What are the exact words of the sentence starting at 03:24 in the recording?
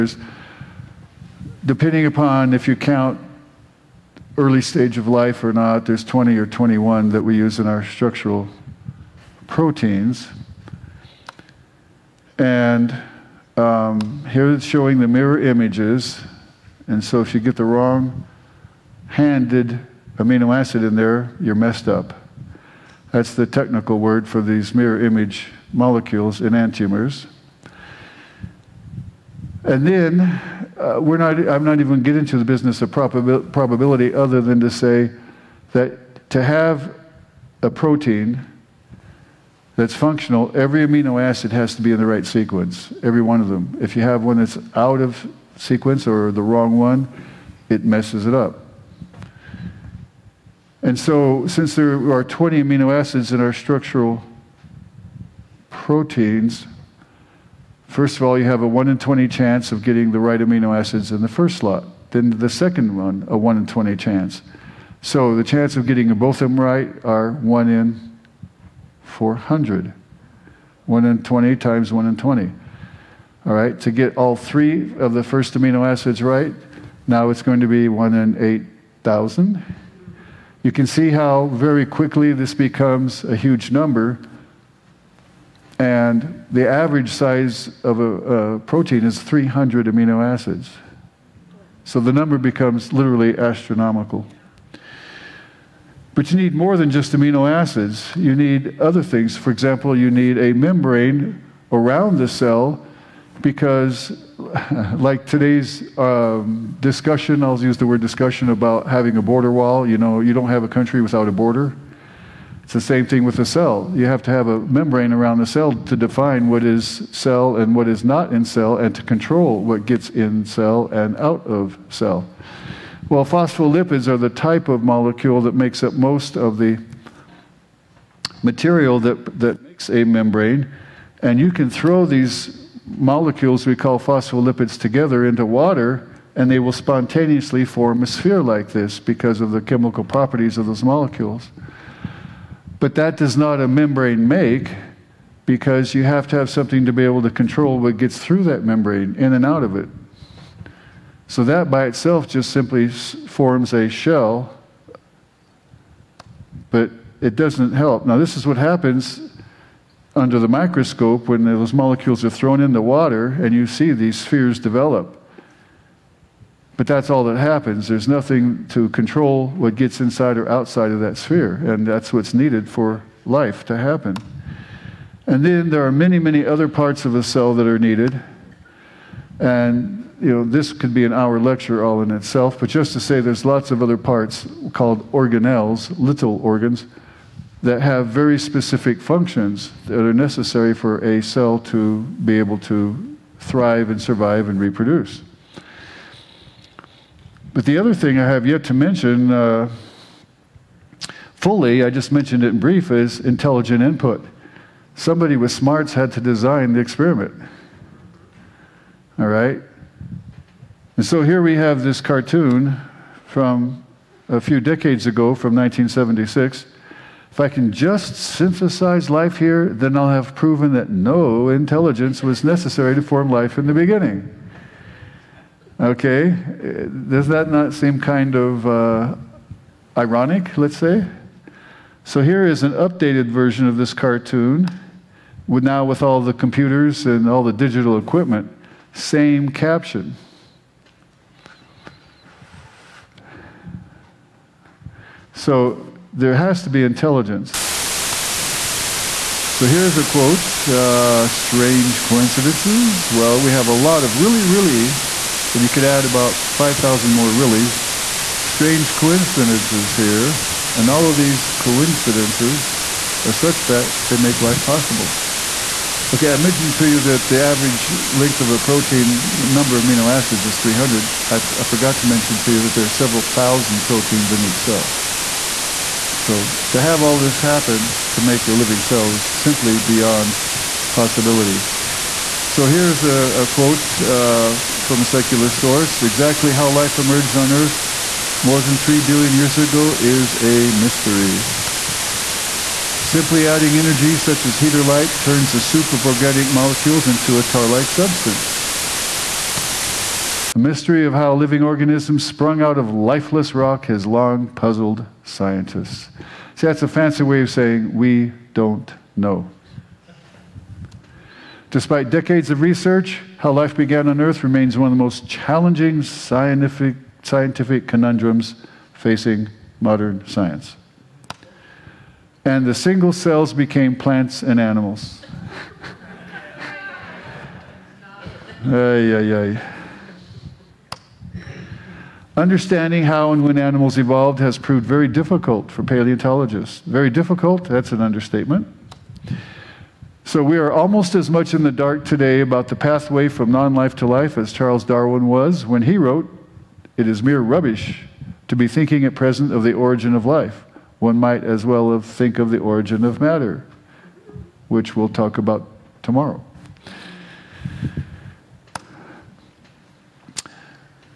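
Somebody with smarts had to design the experiment.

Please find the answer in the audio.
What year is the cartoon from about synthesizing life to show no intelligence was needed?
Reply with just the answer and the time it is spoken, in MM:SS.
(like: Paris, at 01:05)
1976, at 03:35.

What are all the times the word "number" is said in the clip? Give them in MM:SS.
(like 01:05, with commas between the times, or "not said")
01:23, 01:32, 04:29.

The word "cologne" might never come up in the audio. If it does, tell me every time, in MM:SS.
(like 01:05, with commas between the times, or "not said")
not said.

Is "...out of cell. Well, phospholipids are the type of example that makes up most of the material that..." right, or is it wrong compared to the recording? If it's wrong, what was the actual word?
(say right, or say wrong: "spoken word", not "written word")
wrong: "molecule", not "example".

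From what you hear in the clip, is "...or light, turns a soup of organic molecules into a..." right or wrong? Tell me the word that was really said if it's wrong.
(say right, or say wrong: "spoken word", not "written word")
right.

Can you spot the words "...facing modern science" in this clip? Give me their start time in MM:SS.
05:18.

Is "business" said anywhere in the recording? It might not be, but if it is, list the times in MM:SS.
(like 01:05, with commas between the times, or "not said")
00:32.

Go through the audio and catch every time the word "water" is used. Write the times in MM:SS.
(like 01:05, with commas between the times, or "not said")
02:15, 02:42.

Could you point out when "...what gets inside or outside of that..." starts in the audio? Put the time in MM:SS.
02:49.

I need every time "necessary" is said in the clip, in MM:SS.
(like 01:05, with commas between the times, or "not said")
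03:10, 03:42.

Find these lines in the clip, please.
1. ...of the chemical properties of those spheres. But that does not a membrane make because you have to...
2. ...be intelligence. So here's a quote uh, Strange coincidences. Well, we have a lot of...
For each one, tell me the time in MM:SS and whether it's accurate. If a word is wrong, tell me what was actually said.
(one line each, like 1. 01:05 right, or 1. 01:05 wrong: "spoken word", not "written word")
1. 02:19 wrong: "molecules", not "spheres"
2. 04:06 right.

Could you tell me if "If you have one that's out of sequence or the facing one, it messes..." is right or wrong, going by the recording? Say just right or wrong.
wrong.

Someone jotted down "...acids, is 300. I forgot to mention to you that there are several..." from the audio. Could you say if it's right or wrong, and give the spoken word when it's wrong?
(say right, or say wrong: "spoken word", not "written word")
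right.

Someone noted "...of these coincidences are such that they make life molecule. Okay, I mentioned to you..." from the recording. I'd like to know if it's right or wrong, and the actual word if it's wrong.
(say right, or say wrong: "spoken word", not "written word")
wrong: "possible", not "molecule".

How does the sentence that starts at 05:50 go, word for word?
One might as well think of the origin of matter, which we'll talk about tomorrow.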